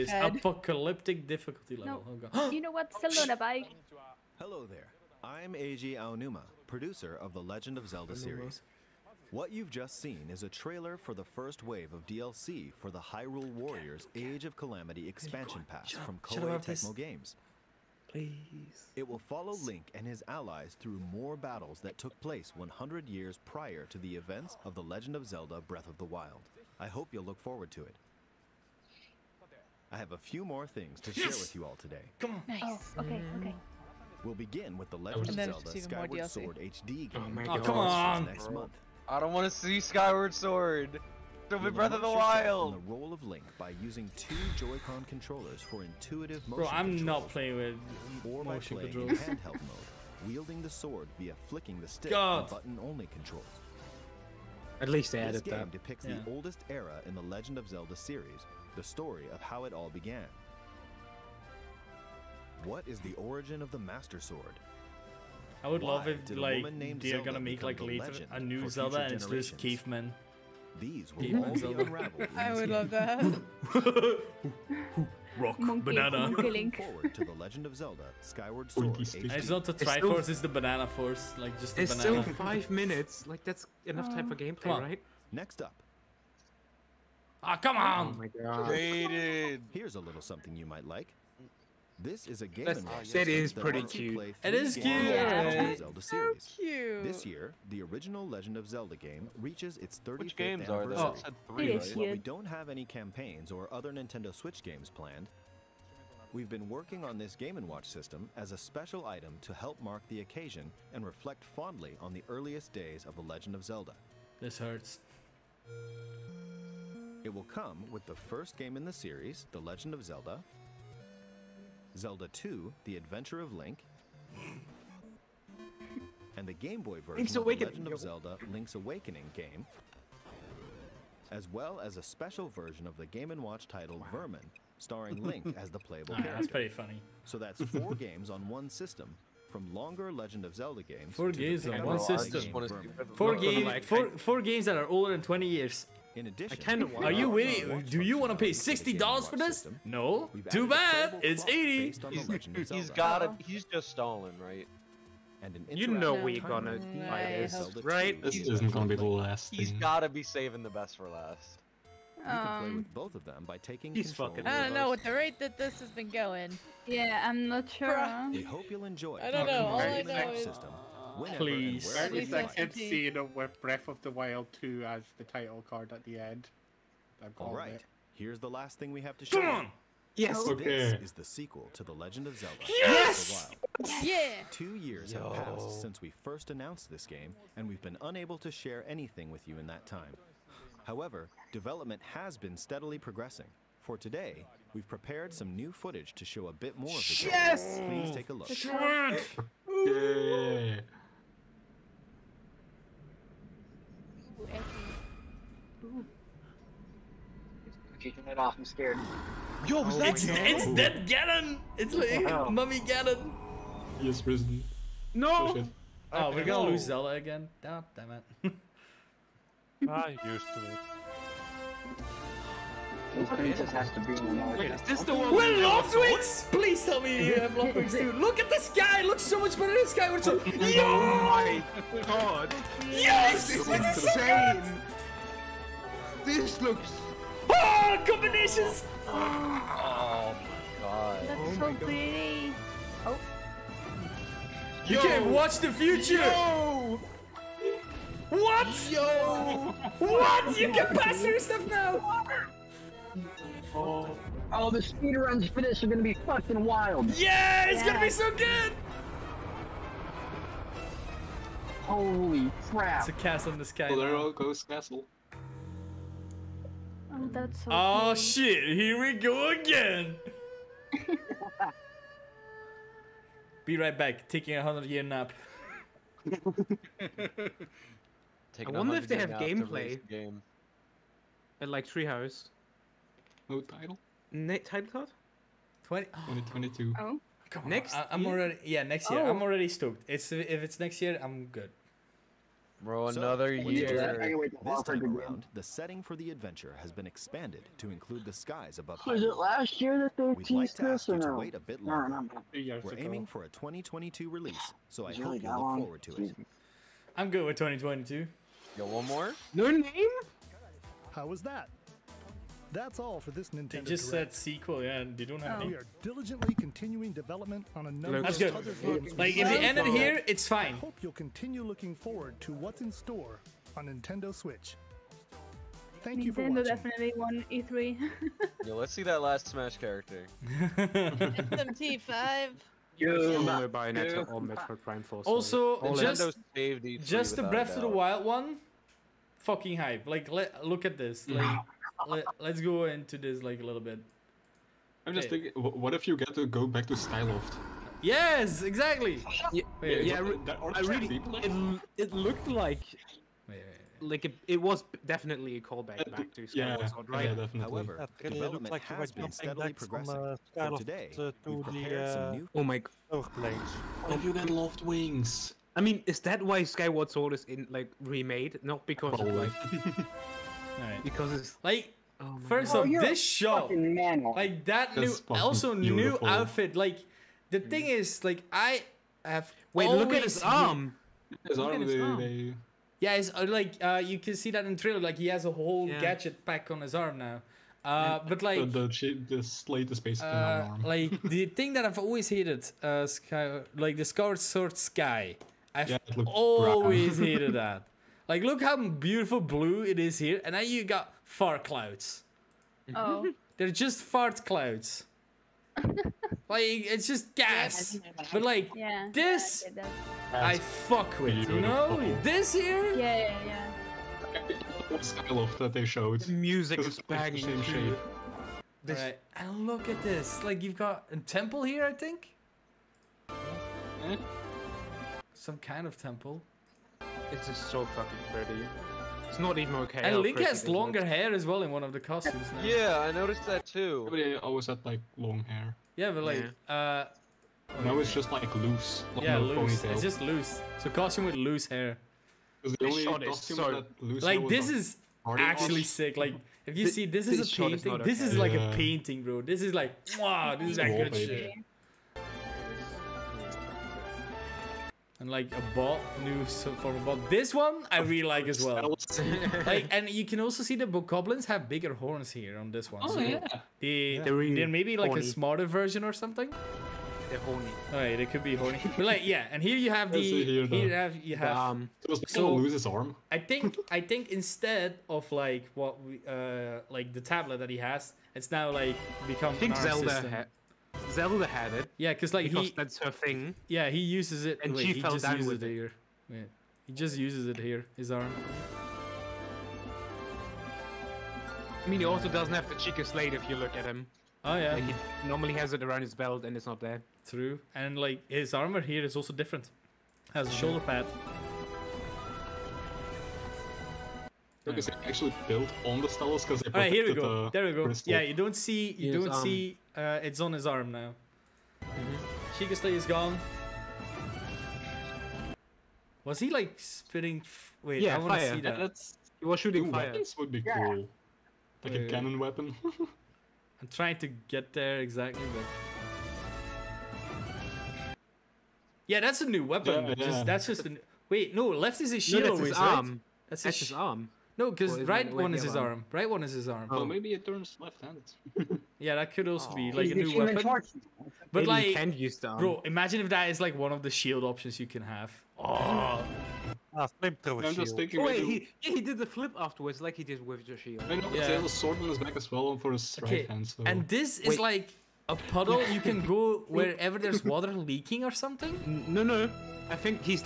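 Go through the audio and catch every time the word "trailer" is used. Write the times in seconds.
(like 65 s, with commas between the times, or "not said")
10 s, 384 s.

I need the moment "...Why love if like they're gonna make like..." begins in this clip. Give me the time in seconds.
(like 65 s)
65 s.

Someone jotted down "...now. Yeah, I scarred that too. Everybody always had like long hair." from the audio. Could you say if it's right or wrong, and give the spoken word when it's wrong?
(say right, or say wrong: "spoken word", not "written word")
wrong: "noticed", not "scarred".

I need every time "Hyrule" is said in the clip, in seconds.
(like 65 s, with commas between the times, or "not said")
12 s.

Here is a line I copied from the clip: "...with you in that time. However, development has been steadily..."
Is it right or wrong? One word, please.
right.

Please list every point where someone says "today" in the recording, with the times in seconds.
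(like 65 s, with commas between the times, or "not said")
31 s, 193 s, 360 s.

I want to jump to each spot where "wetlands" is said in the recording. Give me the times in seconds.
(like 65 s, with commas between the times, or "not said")
not said.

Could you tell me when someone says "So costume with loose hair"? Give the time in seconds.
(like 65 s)
440 s.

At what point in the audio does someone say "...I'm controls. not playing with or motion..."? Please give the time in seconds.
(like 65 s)
46 s.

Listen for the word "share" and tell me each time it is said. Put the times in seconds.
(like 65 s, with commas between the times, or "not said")
31 s, 188 s.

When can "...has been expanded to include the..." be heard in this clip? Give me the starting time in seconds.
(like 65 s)
296 s.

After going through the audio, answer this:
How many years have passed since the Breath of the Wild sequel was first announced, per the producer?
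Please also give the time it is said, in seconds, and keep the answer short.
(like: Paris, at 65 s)
Two years, at 184 s.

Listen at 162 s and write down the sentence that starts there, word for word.
You can play um, with both of them by taking he's control.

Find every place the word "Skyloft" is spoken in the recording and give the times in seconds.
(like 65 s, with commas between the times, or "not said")
346 s, 360 s.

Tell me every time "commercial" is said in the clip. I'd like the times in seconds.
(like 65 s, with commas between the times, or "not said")
not said.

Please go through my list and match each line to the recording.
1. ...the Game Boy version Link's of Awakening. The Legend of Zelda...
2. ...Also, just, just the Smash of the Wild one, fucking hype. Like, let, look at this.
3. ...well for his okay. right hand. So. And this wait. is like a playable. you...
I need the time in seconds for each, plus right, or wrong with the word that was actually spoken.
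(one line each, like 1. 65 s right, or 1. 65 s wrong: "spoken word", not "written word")
1. 126 s right
2. 335 s wrong: "Breath", not "Smash"
3. 552 s wrong: "puddle", not "playable".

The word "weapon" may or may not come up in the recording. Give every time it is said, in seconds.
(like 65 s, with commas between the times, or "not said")
522 s, 529 s, 540 s.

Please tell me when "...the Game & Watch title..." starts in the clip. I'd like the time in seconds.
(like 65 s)
132 s.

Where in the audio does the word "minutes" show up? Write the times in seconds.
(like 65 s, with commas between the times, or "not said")
82 s.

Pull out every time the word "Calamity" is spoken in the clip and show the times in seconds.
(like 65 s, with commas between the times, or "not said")
14 s.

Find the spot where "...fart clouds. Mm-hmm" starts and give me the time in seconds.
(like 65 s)
401 s.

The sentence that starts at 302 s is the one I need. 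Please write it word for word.
No, no, We're aiming for a 2022 release, so I hope you look long.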